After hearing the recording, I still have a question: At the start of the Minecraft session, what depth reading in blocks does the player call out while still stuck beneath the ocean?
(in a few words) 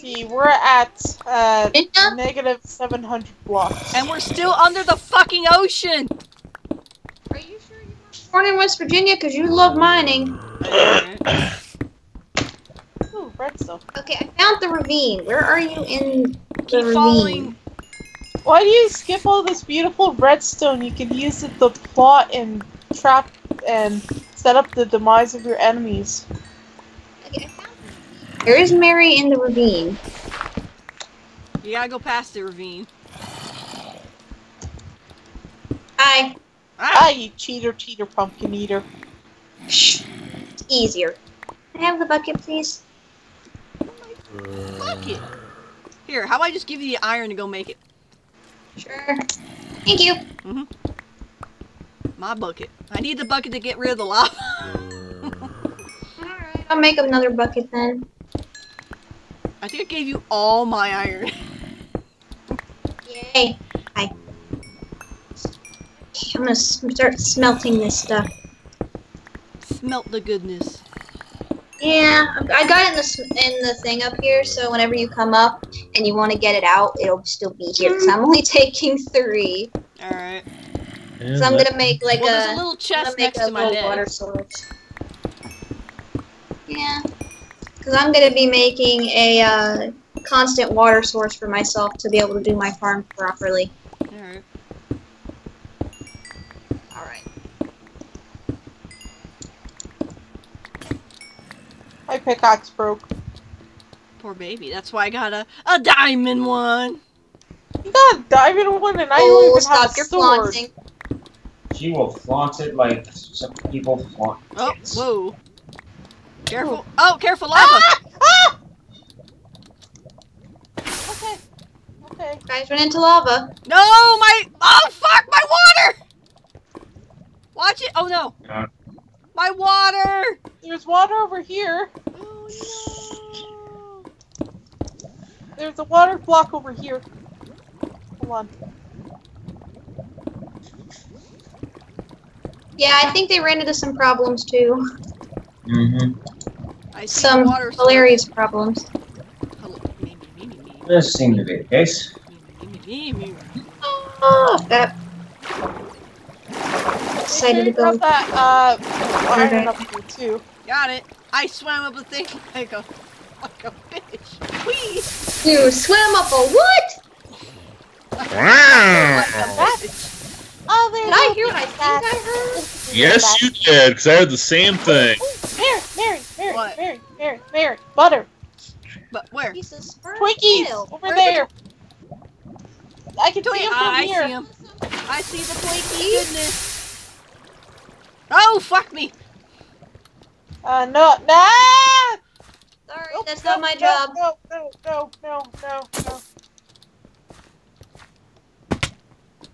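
-700.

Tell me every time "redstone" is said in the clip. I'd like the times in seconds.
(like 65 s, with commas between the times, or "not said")
13 s, 20 s.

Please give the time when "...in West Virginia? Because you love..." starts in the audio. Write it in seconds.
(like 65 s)
8 s.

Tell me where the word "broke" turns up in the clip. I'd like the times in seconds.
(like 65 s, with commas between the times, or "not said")
102 s.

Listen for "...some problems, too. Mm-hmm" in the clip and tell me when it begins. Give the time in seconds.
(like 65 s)
143 s.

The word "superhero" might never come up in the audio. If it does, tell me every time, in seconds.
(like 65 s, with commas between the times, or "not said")
not said.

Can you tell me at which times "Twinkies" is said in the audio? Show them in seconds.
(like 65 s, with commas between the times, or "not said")
179 s, 186 s.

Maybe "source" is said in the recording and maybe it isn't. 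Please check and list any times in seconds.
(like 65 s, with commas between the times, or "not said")
84 s, 91 s.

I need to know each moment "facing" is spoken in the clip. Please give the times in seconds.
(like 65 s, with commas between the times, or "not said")
not said.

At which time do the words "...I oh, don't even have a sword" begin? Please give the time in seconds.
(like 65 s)
109 s.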